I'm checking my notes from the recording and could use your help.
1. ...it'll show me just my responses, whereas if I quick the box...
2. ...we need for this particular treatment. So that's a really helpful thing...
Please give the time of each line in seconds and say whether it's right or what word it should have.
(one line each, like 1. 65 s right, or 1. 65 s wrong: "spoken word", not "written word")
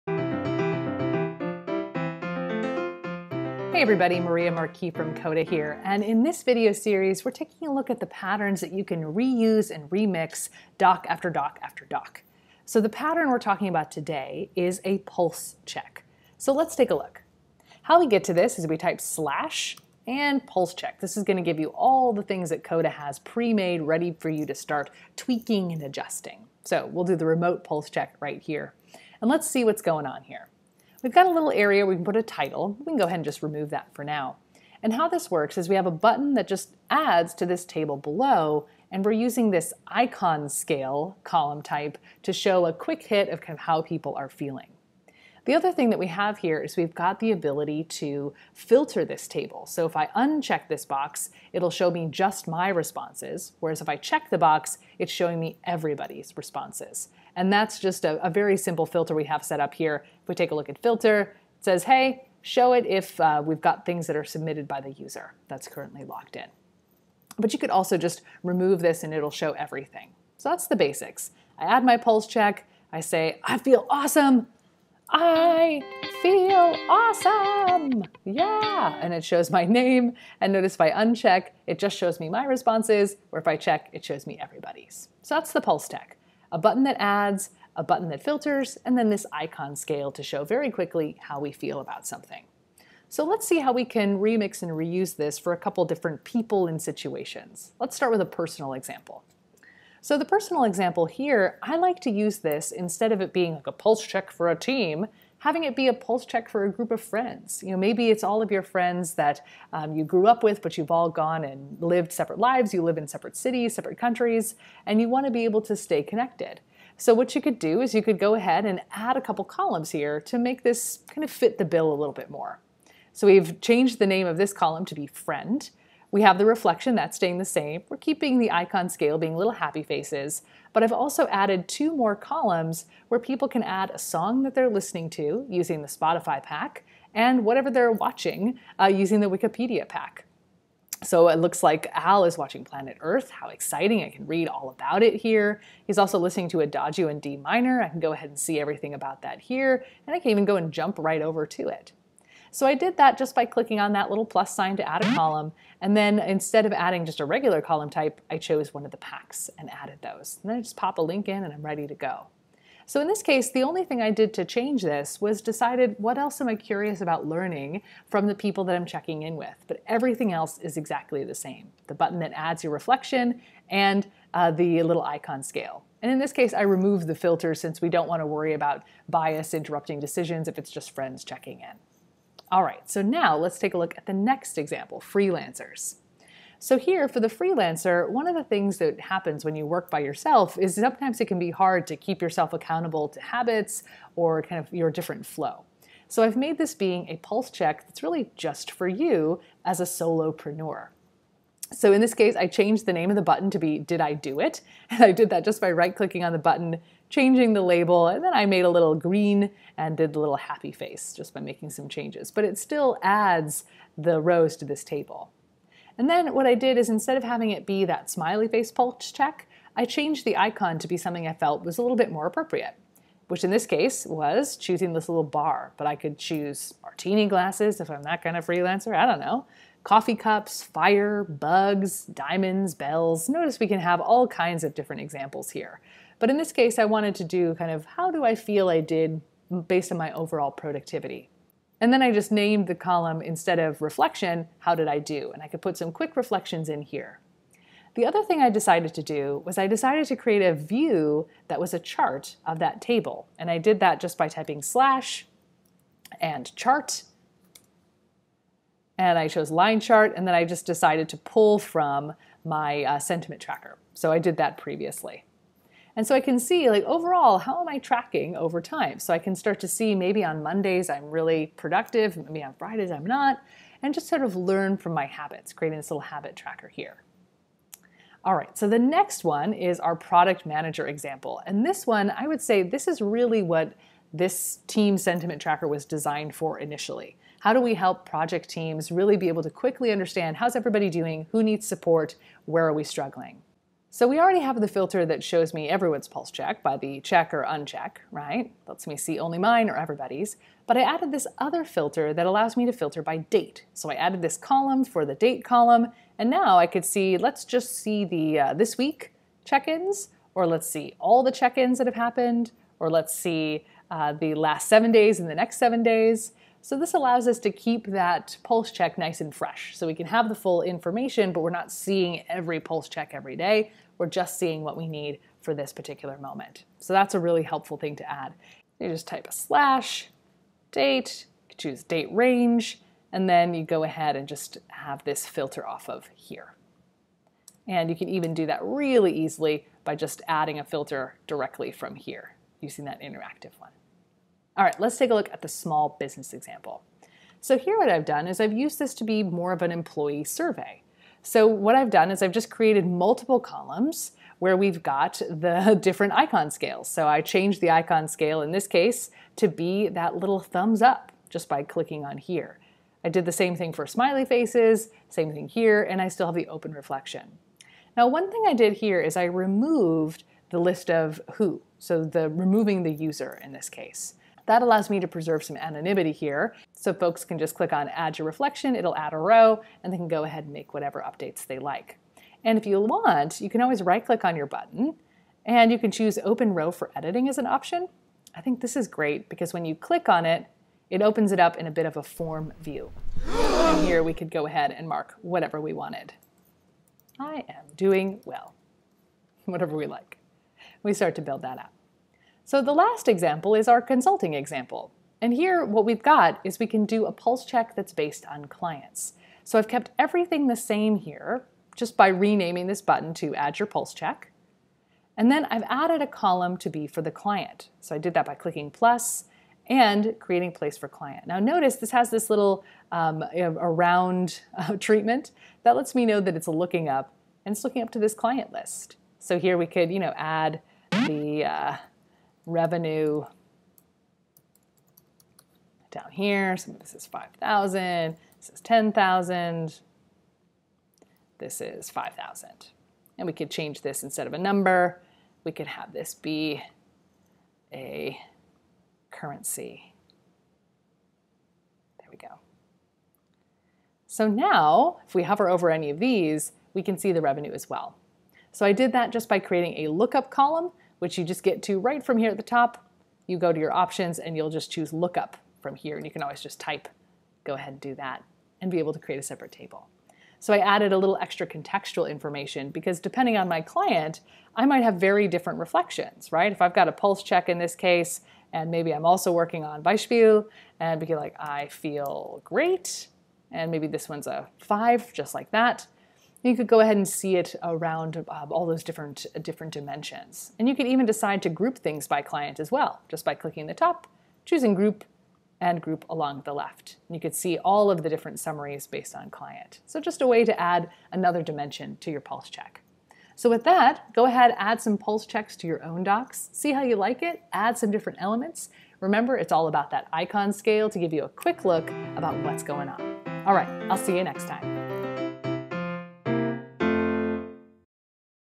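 1. 51 s wrong: "check", not "quick"
2. 324 s wrong: "moment", not "treatment".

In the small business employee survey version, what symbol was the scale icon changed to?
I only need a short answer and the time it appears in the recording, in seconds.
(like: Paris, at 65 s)
thumbs up, at 360 s.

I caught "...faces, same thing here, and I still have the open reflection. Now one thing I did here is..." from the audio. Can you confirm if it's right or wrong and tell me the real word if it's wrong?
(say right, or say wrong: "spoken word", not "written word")
right.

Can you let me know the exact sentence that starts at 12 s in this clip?
So the pattern we're talking about today is a pulse check.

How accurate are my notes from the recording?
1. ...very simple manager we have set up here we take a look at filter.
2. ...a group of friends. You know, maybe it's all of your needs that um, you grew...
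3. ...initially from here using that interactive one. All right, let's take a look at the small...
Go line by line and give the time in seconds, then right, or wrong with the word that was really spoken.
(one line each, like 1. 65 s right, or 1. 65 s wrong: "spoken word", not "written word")
1. 58 s wrong: "filter", not "manager"
2. 106 s wrong: "friends", not "needs"
3. 341 s wrong: "directly", not "initially".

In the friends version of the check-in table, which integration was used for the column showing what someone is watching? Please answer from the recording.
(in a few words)
Wikipedia pack.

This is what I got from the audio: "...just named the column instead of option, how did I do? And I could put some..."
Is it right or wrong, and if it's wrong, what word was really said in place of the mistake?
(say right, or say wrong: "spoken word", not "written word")
wrong: "reflection", not "option".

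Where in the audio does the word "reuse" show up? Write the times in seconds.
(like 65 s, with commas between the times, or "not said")
9 s, 94 s.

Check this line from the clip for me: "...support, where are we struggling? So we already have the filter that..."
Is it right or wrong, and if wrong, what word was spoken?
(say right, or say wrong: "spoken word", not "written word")
right.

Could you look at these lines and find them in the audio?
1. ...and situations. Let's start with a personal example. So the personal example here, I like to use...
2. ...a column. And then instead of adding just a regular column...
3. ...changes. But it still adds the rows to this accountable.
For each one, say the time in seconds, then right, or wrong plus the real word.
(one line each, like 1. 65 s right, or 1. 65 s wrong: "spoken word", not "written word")
1. 96 s right
2. 155 s right
3. 211 s wrong: "table", not "accountable".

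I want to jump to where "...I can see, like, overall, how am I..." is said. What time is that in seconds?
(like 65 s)
266 s.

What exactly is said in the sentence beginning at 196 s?
So I've made this being a pulse check that's really just for you as a solopreneur.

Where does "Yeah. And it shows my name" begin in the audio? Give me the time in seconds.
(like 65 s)
78 s.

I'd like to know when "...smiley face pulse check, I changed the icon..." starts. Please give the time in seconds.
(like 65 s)
218 s.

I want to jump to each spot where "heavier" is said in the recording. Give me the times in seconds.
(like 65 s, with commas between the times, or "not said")
not said.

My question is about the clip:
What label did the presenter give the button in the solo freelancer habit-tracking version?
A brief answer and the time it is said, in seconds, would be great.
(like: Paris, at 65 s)
Did I Do It?, at 203 s.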